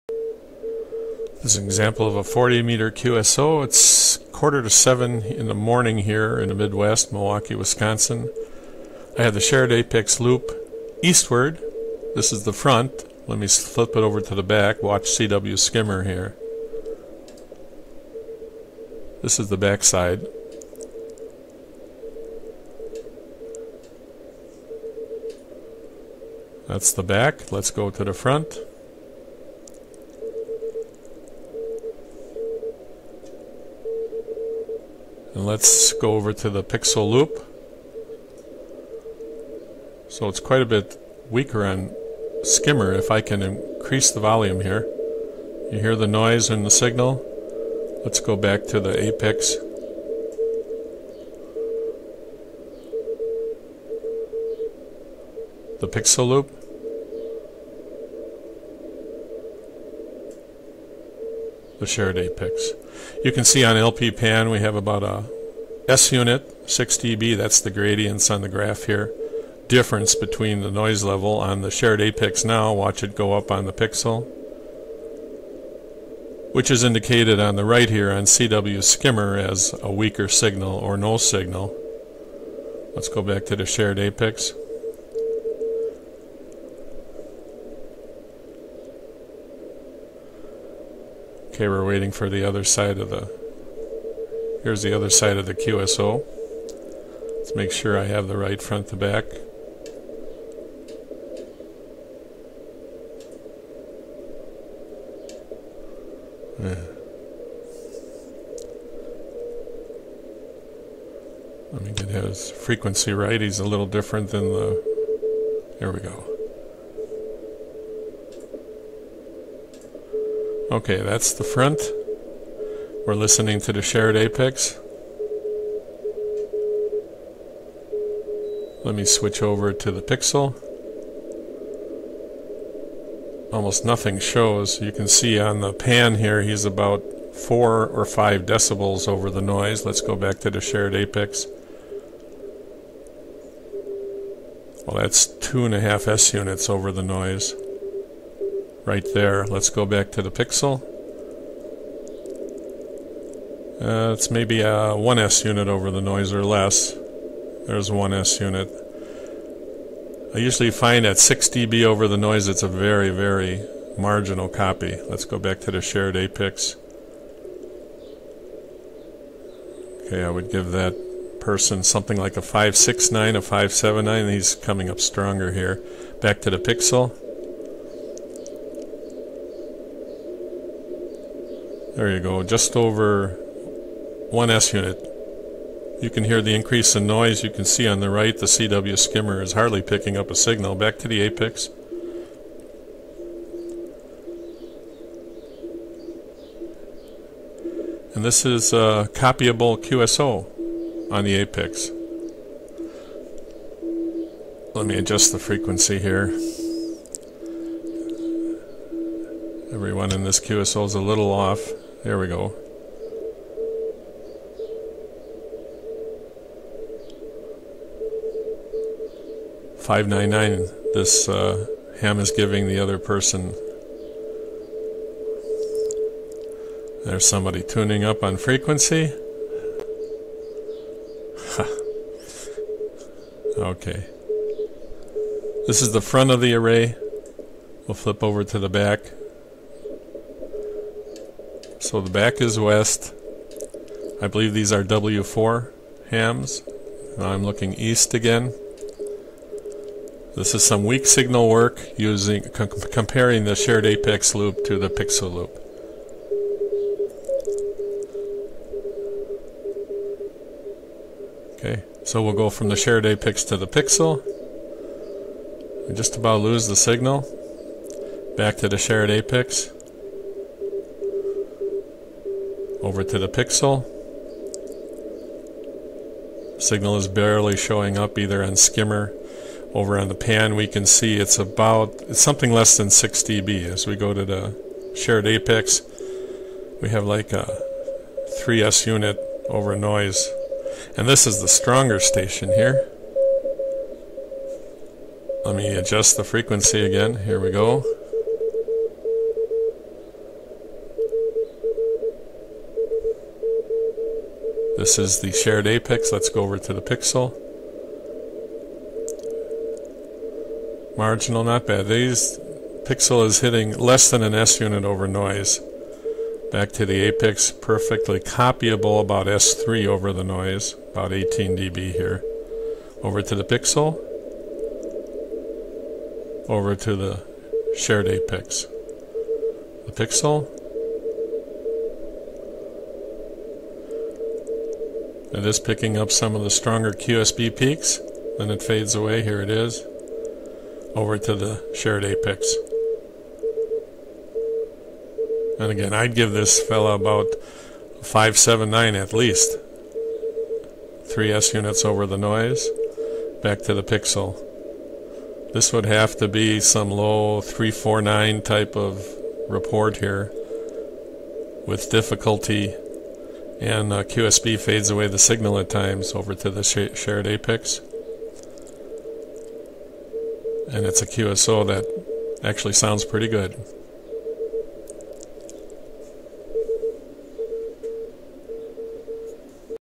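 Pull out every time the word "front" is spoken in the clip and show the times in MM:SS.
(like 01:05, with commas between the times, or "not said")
00:12, 00:28, 01:38, 02:01, 03:56.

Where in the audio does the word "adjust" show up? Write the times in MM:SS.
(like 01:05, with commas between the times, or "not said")
03:24, 04:55.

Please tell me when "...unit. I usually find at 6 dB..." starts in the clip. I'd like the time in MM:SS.
02:38.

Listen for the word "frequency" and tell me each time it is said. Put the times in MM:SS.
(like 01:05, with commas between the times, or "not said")
01:52, 03:25, 03:48, 04:56.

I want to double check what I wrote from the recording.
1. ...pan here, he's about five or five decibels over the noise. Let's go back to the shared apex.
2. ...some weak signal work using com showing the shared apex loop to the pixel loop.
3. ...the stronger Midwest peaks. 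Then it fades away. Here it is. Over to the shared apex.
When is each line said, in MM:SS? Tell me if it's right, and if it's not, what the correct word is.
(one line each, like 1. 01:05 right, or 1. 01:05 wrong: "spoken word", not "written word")
1. 02:15 wrong: "four", not "five"
2. 04:10 wrong: "comparing", not "showing"
3. 05:36 wrong: "QSB", not "Midwest".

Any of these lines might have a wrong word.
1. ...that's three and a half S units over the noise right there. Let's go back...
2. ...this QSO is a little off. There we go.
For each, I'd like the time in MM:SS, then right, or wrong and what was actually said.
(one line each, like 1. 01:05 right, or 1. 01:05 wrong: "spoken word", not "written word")
1. 02:25 wrong: "two", not "three"
2. 03:30 right.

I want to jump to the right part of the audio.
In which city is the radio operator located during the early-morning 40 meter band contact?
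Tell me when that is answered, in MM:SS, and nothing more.
00:07.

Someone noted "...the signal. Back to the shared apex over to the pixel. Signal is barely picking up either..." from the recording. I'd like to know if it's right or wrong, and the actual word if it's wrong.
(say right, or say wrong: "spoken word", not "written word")
wrong: "showing", not "picking".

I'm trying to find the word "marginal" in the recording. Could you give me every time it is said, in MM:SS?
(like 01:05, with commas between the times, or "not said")
02:43, 05:10.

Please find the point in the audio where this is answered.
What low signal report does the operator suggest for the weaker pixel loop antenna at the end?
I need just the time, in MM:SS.
05:57.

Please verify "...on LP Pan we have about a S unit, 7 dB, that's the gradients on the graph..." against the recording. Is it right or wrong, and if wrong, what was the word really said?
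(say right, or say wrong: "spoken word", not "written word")
wrong: "6", not "7".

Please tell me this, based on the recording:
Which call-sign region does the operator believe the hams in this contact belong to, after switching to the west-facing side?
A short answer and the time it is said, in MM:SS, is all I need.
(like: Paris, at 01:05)
W4, at 04:04.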